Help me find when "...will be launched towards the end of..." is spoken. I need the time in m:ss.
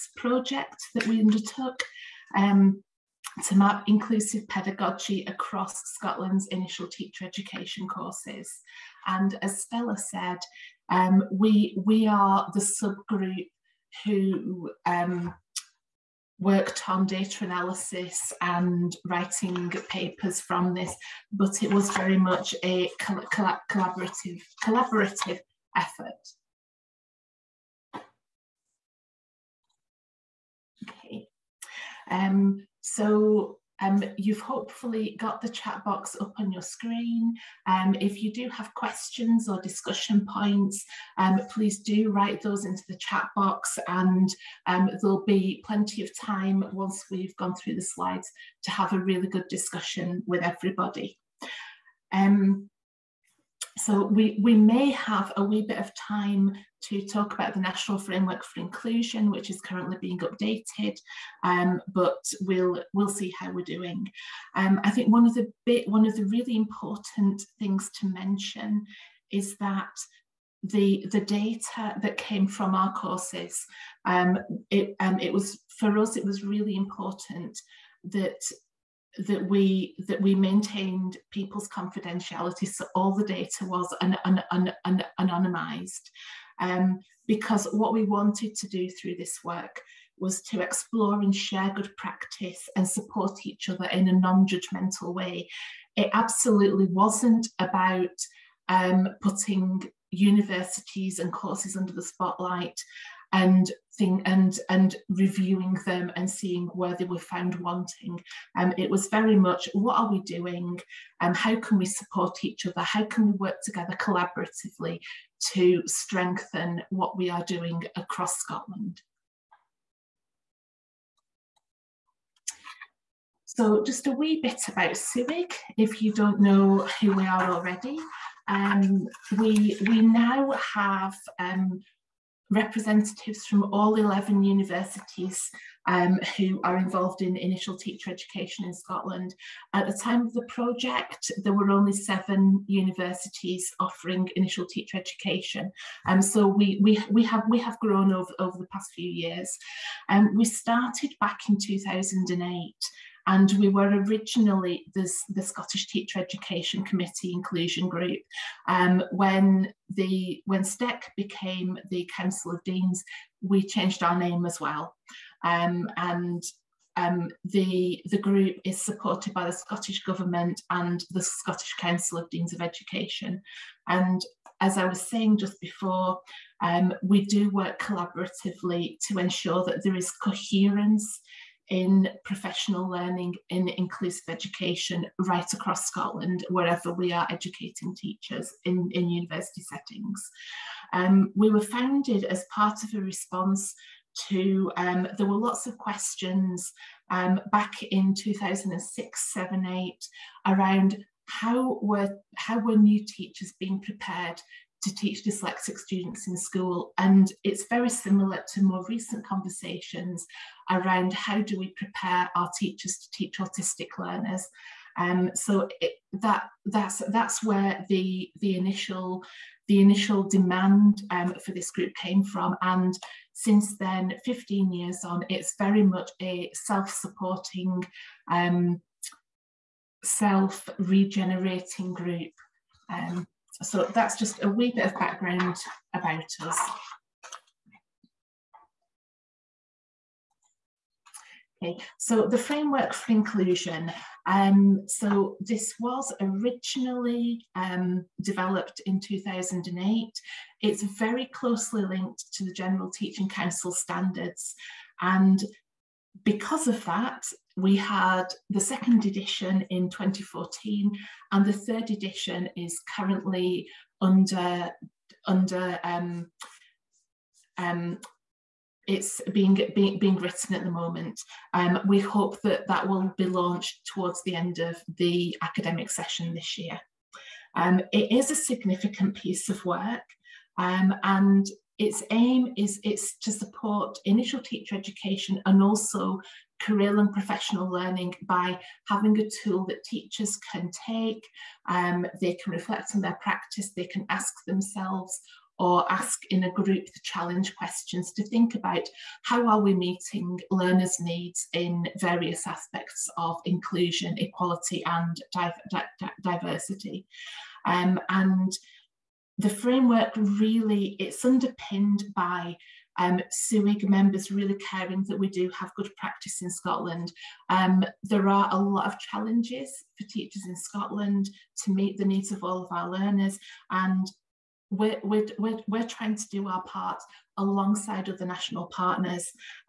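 4:32.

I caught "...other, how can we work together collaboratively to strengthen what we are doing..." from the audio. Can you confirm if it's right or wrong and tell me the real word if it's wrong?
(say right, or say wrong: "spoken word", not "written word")
right.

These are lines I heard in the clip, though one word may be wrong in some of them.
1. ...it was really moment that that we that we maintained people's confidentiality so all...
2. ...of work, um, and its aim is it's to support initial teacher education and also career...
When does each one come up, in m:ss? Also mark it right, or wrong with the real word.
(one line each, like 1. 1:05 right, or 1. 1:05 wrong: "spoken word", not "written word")
1. 1:16 wrong: "important", not "moment"
2. 4:39 right.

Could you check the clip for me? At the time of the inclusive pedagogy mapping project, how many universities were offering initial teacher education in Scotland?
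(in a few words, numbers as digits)
7.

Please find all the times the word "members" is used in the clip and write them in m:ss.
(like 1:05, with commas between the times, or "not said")
5:13.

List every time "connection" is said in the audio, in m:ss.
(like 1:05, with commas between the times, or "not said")
not said.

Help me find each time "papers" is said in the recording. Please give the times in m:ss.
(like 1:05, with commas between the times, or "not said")
0:19.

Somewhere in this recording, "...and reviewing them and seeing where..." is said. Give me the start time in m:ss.
1:44.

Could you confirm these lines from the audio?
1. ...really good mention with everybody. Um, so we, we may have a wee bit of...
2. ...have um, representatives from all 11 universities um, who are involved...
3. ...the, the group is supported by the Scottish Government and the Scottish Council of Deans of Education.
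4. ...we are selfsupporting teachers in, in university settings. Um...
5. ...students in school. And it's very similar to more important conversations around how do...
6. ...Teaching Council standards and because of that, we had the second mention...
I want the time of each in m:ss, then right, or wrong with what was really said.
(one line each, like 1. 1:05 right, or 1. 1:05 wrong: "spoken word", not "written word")
1. 0:48 wrong: "discussion", not "mention"
2. 2:10 right
3. 2:47 right
4. 3:06 wrong: "educating", not "selfsupporting"
5. 3:25 wrong: "recent", not "important"
6. 4:12 wrong: "edition", not "mention".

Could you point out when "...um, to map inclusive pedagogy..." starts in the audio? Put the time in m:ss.
0:02.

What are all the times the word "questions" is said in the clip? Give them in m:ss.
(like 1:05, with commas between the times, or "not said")
0:38, 3:15, 4:57.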